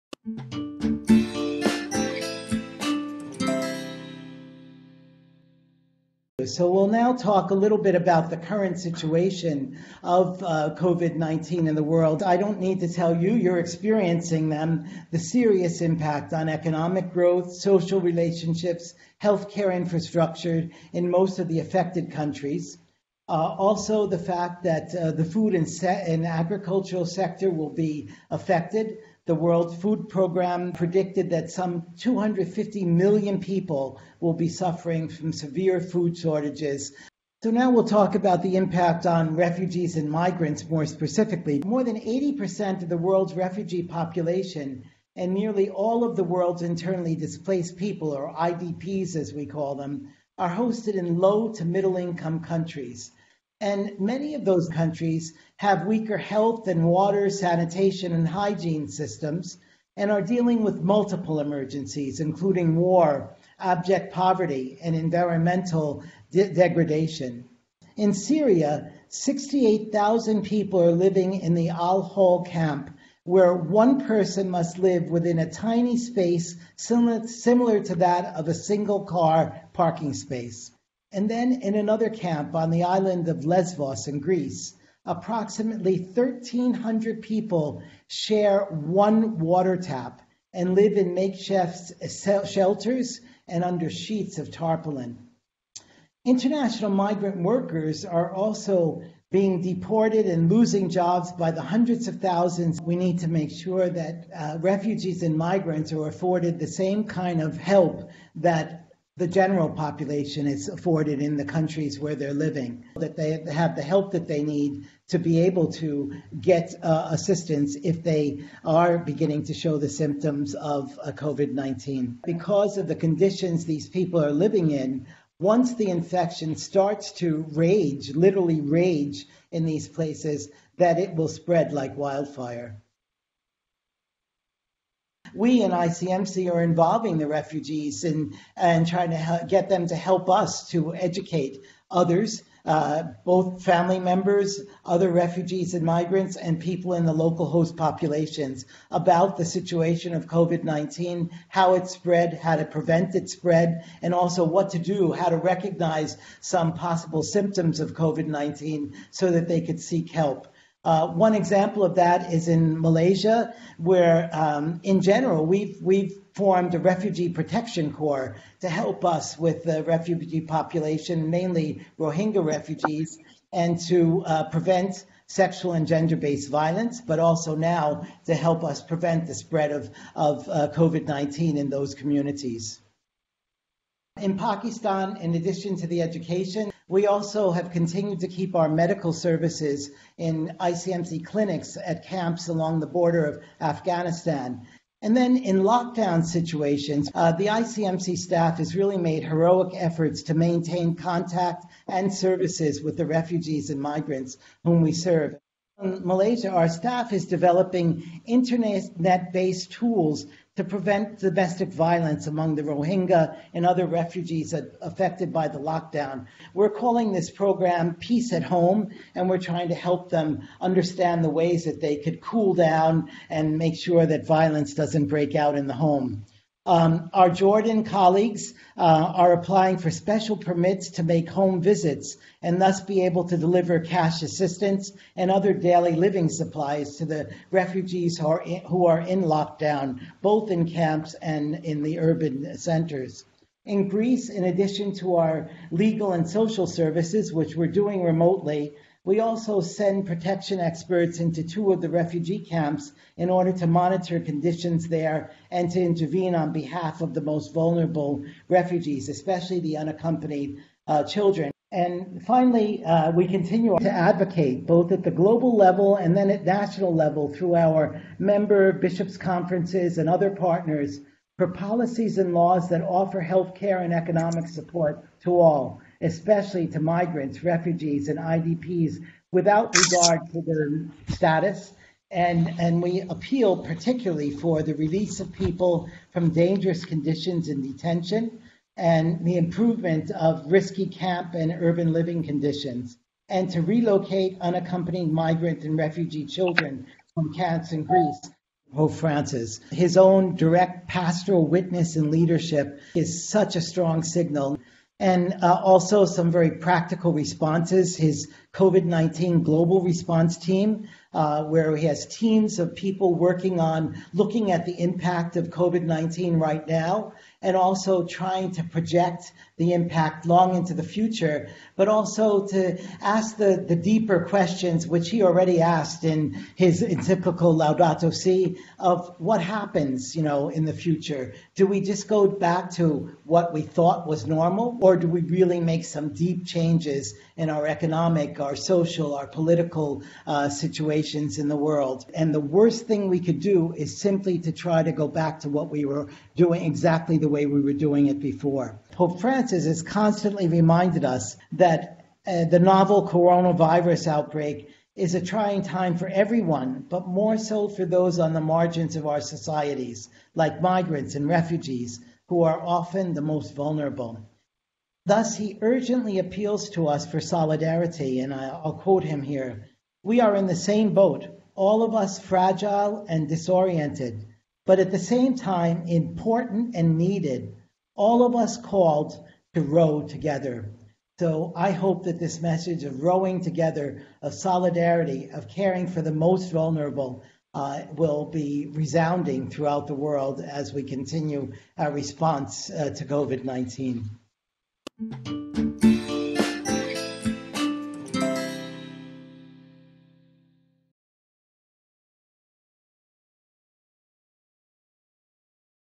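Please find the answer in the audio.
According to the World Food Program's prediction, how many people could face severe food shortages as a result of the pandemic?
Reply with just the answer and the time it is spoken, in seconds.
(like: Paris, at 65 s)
250 million, at 31 s.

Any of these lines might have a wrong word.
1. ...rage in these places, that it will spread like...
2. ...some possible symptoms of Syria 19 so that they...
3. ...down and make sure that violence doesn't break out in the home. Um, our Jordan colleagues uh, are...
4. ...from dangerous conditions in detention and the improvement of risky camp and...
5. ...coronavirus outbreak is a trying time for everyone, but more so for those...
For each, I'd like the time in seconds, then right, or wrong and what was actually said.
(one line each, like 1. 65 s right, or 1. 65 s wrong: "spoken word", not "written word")
1. 128 s right
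2. 156 s wrong: "COVID", not "Syria"
3. 222 s right
4. 286 s right
5. 353 s right.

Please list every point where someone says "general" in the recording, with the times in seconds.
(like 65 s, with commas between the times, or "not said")
109 s, 165 s.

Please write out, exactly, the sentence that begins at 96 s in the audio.
International migrant workers are also being deported and losing jobs by the hundreds of thousands.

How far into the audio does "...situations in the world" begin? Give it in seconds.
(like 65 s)
340 s.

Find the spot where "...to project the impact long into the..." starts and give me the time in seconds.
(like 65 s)
318 s.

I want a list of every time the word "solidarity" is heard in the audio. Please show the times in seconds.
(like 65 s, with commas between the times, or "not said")
367 s, 384 s.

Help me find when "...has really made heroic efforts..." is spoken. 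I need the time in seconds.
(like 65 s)
198 s.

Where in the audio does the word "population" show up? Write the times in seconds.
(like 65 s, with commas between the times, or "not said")
43 s, 109 s, 147 s, 170 s.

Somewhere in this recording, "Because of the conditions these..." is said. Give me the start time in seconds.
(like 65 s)
122 s.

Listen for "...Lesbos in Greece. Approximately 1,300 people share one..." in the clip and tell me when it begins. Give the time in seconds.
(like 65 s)
83 s.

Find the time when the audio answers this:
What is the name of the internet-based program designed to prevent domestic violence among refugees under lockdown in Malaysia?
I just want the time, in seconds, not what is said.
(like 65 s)
217 s.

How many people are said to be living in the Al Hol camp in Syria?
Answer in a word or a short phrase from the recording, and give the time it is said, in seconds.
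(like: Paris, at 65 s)
68,000, at 69 s.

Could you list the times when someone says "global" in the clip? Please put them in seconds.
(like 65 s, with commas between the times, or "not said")
265 s, 309 s.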